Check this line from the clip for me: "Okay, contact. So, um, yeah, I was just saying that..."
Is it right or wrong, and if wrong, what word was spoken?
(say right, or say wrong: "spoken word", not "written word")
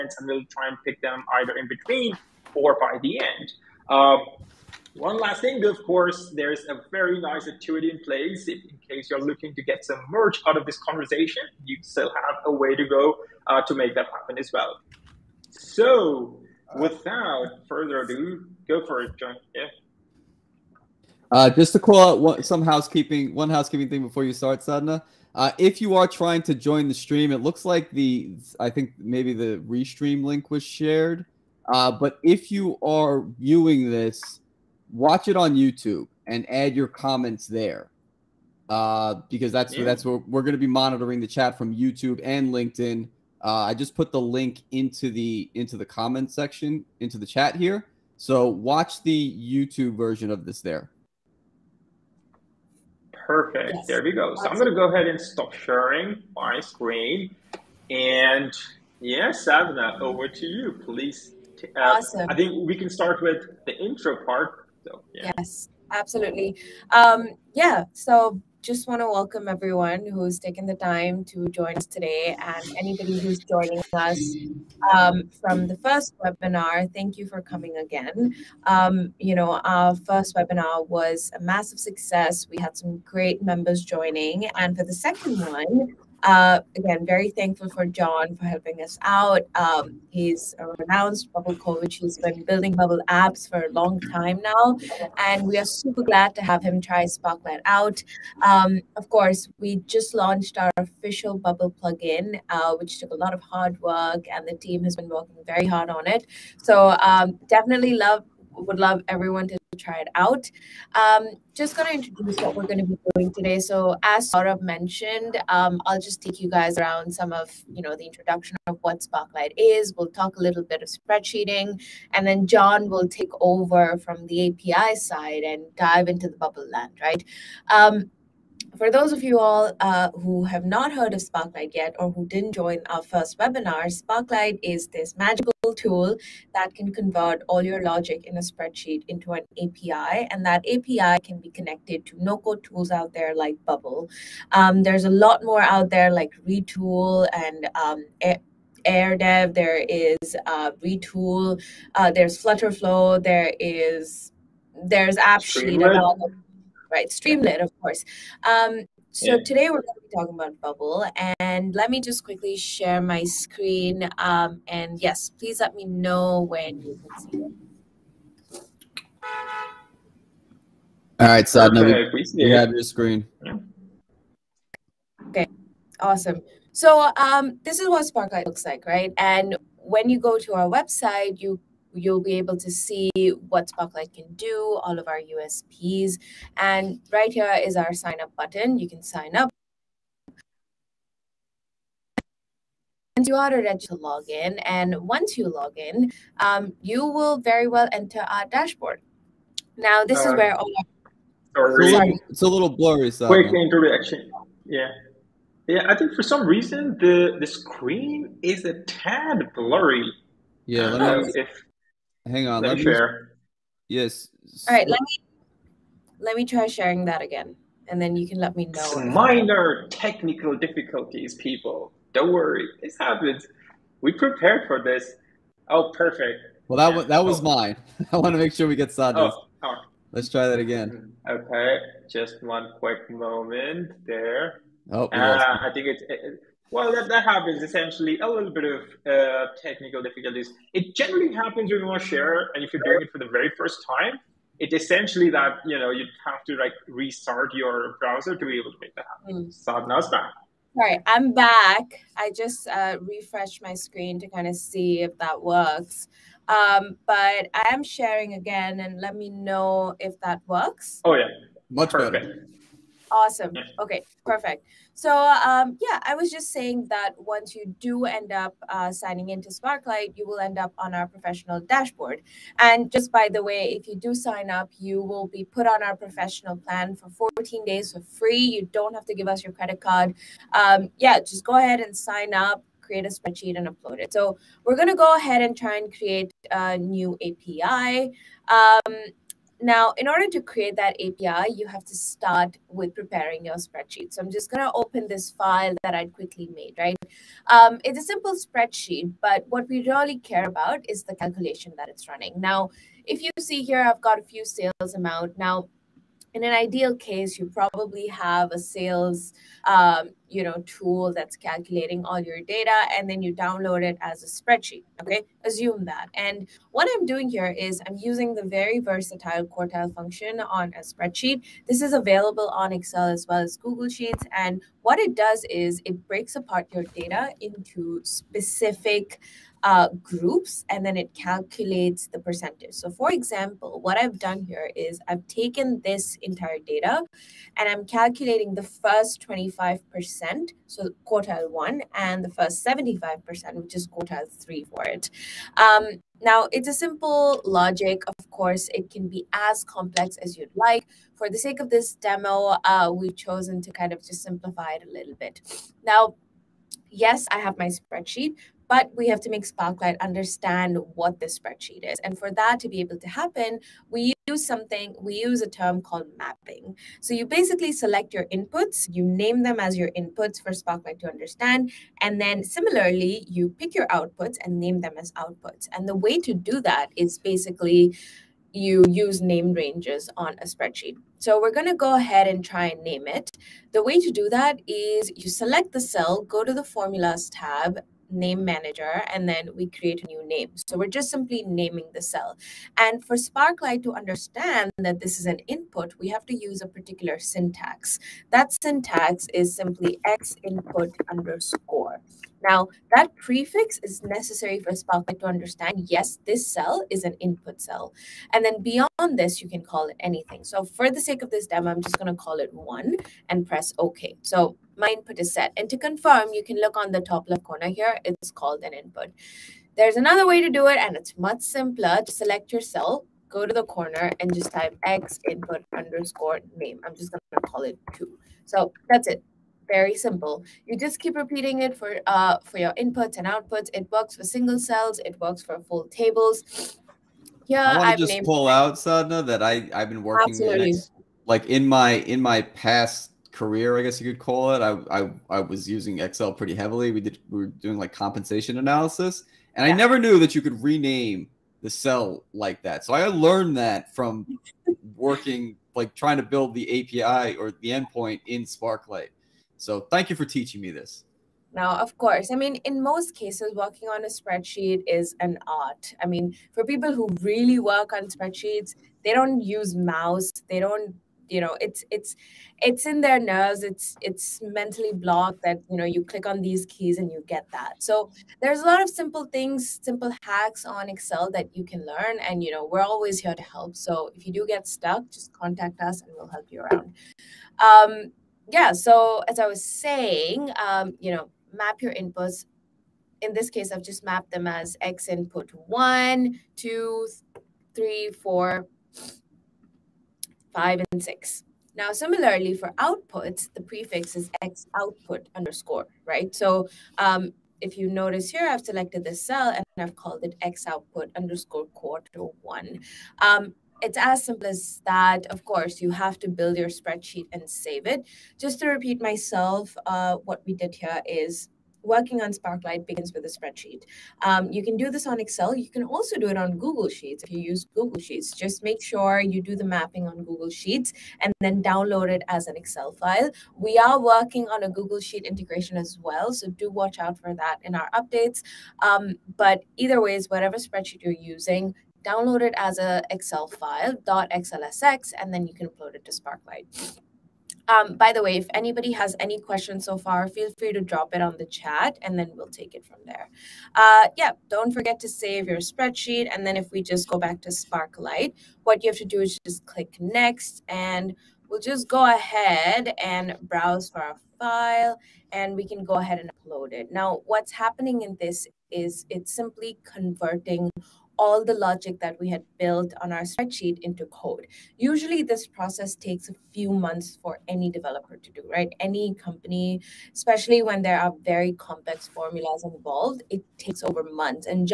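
wrong: "perfect", not "contact".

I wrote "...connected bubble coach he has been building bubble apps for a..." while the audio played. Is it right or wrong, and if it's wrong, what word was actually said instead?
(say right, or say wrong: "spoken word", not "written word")
wrong: "renowned", not "connected".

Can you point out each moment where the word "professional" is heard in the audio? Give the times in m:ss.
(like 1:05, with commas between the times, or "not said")
4:31, 4:35.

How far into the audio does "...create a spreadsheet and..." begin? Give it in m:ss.
4:42.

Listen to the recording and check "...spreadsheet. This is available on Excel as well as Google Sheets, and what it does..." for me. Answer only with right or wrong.
right.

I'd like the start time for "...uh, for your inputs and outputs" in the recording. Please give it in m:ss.
7:12.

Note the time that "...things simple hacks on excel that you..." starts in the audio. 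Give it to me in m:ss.
7:59.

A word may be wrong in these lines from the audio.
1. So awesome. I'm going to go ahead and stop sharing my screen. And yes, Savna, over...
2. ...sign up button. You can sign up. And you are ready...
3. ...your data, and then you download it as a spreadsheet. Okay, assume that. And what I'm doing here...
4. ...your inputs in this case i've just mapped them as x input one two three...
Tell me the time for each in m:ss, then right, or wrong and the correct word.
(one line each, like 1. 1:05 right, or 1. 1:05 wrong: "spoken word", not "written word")
1. 0:54 right
2. 3:07 right
3. 5:12 right
4. 8:11 right.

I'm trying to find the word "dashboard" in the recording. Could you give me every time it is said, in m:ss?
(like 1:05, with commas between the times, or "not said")
3:18, 4:31.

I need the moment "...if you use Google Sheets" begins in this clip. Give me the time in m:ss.
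8:47.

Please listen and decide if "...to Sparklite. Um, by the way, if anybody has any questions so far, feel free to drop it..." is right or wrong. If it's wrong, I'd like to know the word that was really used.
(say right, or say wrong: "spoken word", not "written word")
right.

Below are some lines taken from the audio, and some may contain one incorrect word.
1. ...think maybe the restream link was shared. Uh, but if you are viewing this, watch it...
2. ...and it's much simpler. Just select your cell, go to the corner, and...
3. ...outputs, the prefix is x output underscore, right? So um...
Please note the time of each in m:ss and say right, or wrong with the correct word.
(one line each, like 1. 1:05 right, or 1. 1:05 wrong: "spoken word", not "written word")
1. 0:28 right
2. 7:00 right
3. 8:22 right.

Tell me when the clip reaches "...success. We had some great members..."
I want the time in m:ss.
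1:21.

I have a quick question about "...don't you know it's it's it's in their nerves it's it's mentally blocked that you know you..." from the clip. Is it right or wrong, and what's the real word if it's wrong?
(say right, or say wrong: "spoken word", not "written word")
right.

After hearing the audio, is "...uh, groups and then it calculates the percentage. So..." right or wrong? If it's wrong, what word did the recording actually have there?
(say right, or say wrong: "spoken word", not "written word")
right.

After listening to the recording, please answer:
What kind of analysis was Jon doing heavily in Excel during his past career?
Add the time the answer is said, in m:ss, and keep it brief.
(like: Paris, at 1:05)
compensation analysis, at 7:27.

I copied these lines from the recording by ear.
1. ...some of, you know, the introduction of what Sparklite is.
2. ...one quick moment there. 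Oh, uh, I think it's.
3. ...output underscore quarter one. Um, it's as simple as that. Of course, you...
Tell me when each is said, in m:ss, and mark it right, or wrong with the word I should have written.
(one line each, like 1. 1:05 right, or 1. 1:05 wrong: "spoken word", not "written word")
1. 1:57 right
2. 3:52 right
3. 8:30 right.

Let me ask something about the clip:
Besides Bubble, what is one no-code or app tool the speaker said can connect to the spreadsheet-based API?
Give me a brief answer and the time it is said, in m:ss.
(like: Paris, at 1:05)
Flutterflow, at 2:32.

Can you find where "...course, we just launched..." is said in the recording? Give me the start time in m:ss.
1:39.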